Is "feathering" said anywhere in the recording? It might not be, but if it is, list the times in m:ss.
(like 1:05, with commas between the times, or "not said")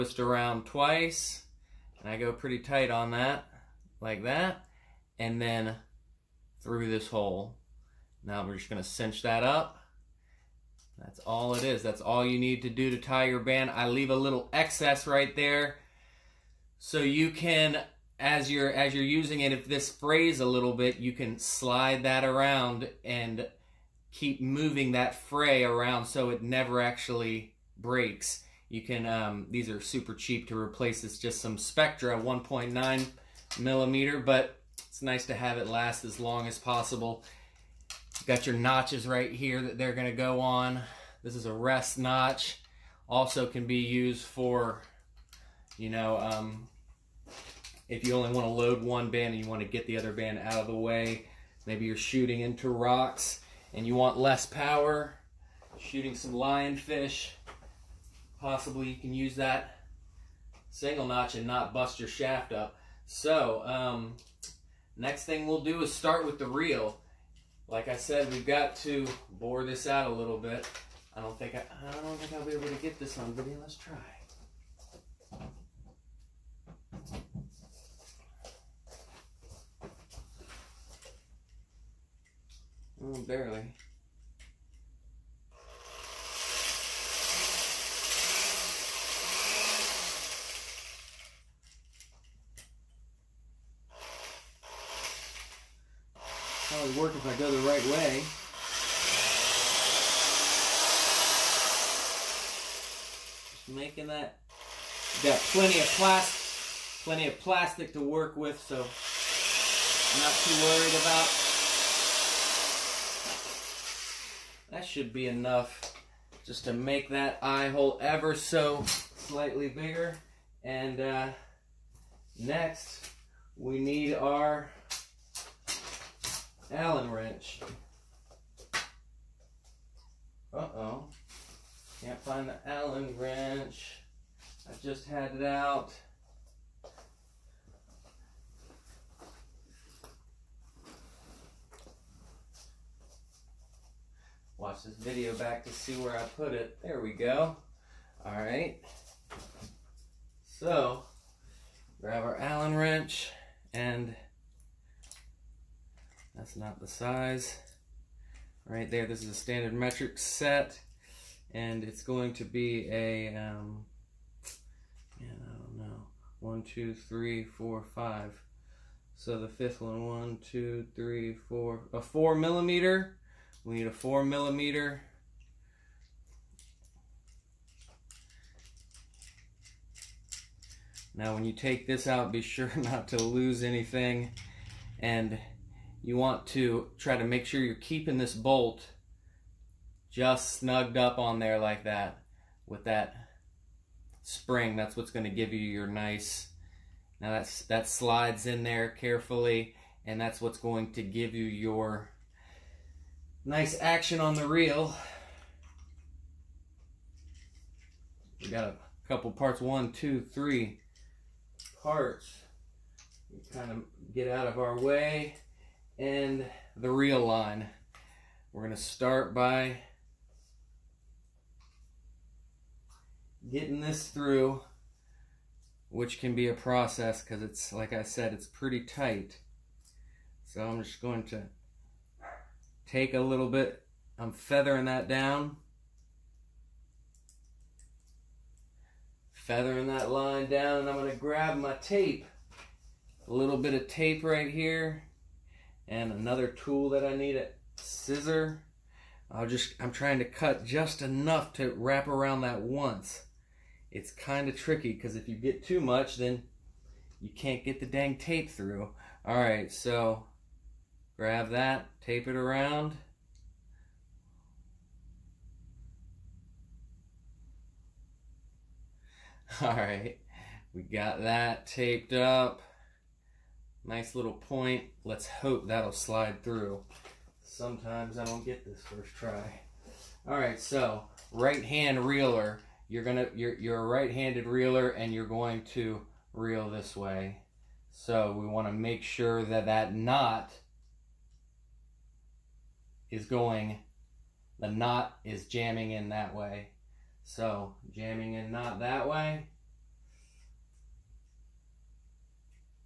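3:54, 3:59.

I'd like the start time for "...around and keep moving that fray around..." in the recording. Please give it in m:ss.
0:22.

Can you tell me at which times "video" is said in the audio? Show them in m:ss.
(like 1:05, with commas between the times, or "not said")
1:13, 2:24.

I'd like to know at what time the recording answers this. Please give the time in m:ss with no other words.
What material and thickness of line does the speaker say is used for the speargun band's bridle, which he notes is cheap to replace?
0:31.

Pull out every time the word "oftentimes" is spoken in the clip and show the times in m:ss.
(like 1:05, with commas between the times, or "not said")
not said.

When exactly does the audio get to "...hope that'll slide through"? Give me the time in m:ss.
4:35.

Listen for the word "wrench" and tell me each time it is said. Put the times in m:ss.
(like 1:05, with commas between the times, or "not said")
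2:07, 2:13, 2:32.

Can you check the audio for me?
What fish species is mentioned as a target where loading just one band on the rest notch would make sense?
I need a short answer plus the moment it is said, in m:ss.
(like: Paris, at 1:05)
lionfish, at 0:56.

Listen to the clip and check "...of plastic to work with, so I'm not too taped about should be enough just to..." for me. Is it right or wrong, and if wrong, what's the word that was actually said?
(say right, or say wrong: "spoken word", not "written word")
wrong: "worried", not "taped".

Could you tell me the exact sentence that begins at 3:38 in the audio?
We're going to start by getting this through, which can be a process because it's, like I said, it's pretty tight.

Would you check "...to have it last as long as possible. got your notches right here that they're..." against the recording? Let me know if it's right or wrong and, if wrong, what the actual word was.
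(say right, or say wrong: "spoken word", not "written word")
right.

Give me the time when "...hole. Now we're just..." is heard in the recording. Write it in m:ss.
0:07.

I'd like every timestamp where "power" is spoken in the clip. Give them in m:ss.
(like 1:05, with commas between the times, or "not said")
0:54.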